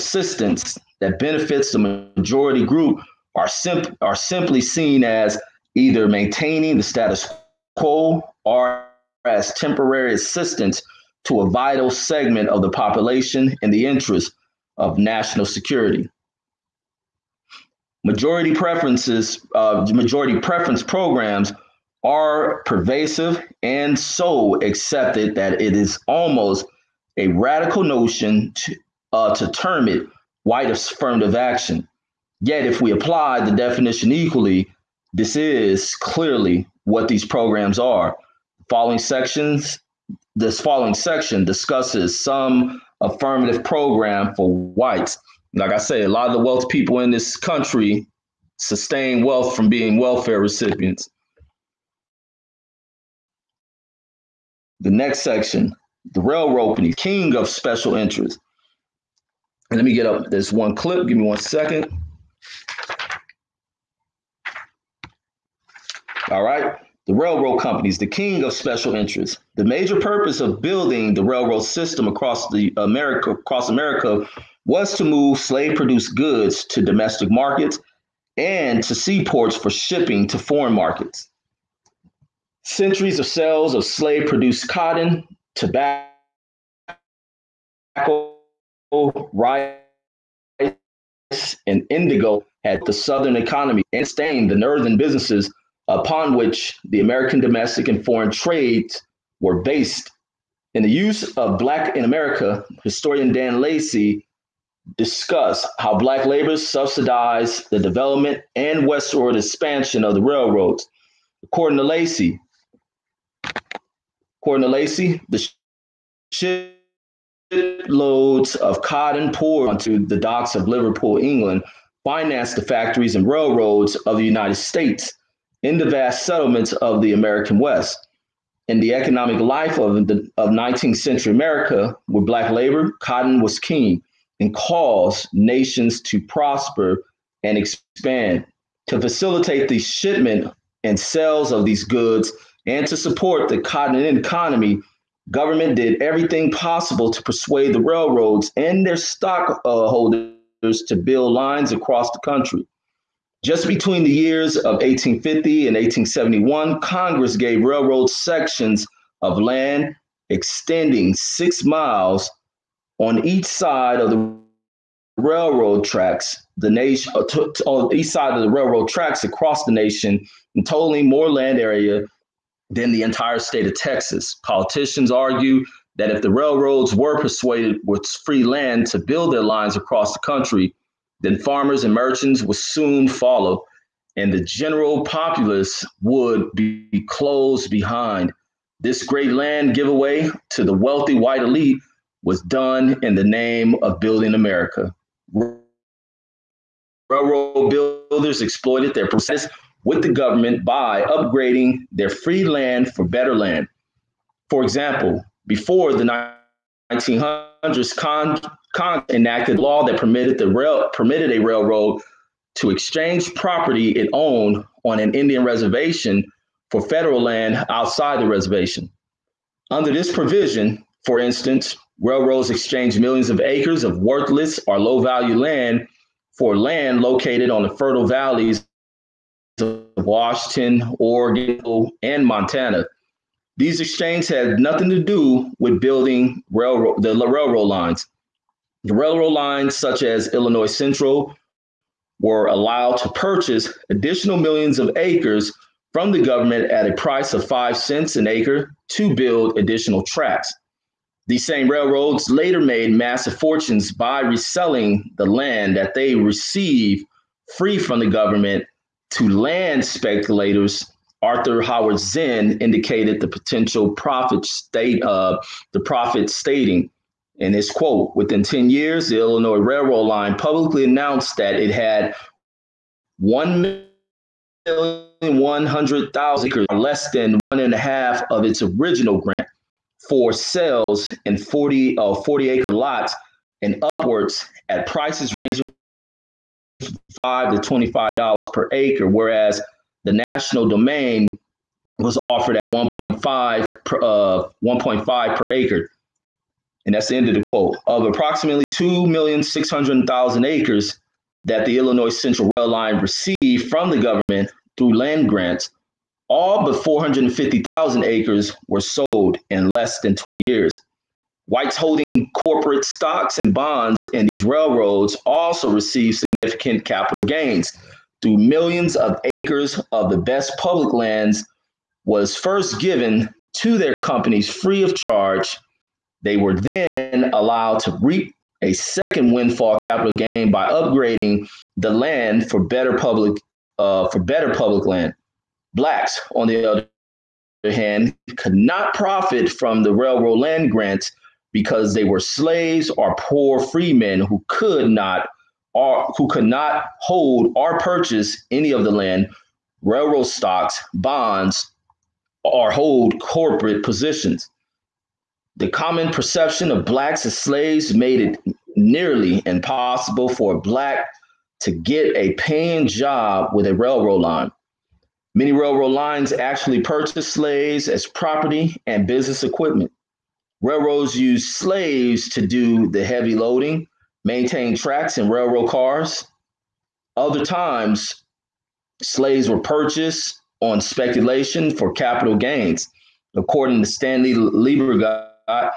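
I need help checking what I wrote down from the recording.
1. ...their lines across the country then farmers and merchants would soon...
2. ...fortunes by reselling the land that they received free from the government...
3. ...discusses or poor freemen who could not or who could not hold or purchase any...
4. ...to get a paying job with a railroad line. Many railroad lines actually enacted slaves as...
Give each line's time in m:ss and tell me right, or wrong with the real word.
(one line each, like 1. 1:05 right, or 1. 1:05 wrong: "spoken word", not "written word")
1. 2:59 right
2. 4:13 right
3. 5:42 wrong: "slaves", not "discusses"
4. 6:01 wrong: "purchased", not "enacted".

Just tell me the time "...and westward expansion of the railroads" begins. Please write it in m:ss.
1:48.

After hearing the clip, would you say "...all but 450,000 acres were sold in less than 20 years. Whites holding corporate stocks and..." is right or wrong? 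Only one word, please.
right.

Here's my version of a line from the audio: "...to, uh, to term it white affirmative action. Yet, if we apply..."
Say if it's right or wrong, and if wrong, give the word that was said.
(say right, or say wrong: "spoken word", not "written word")
right.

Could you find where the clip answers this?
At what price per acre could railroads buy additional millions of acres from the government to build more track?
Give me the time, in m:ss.
4:07.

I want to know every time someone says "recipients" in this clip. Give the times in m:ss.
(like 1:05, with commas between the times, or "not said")
0:50.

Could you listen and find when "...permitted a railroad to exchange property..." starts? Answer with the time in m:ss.
3:30.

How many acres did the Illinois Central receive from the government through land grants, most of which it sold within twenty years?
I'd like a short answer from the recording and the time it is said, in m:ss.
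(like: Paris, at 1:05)
2,600,000, at 4:58.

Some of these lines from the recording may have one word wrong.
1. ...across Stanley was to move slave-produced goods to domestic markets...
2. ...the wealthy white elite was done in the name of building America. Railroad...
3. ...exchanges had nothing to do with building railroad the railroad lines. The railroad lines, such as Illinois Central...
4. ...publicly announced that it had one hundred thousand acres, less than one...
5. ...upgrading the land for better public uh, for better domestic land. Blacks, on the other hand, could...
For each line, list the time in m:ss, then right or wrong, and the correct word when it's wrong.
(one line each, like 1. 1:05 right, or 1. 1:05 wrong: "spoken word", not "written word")
1. 1:13 wrong: "America", not "Stanley"
2. 3:10 right
3. 3:53 right
4. 4:30 right
5. 5:30 wrong: "public", not "domestic".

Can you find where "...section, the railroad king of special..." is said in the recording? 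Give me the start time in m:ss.
0:55.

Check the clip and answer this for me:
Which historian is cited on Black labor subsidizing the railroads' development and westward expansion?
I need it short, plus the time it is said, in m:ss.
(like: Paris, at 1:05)
Dan Lacy, at 1:43.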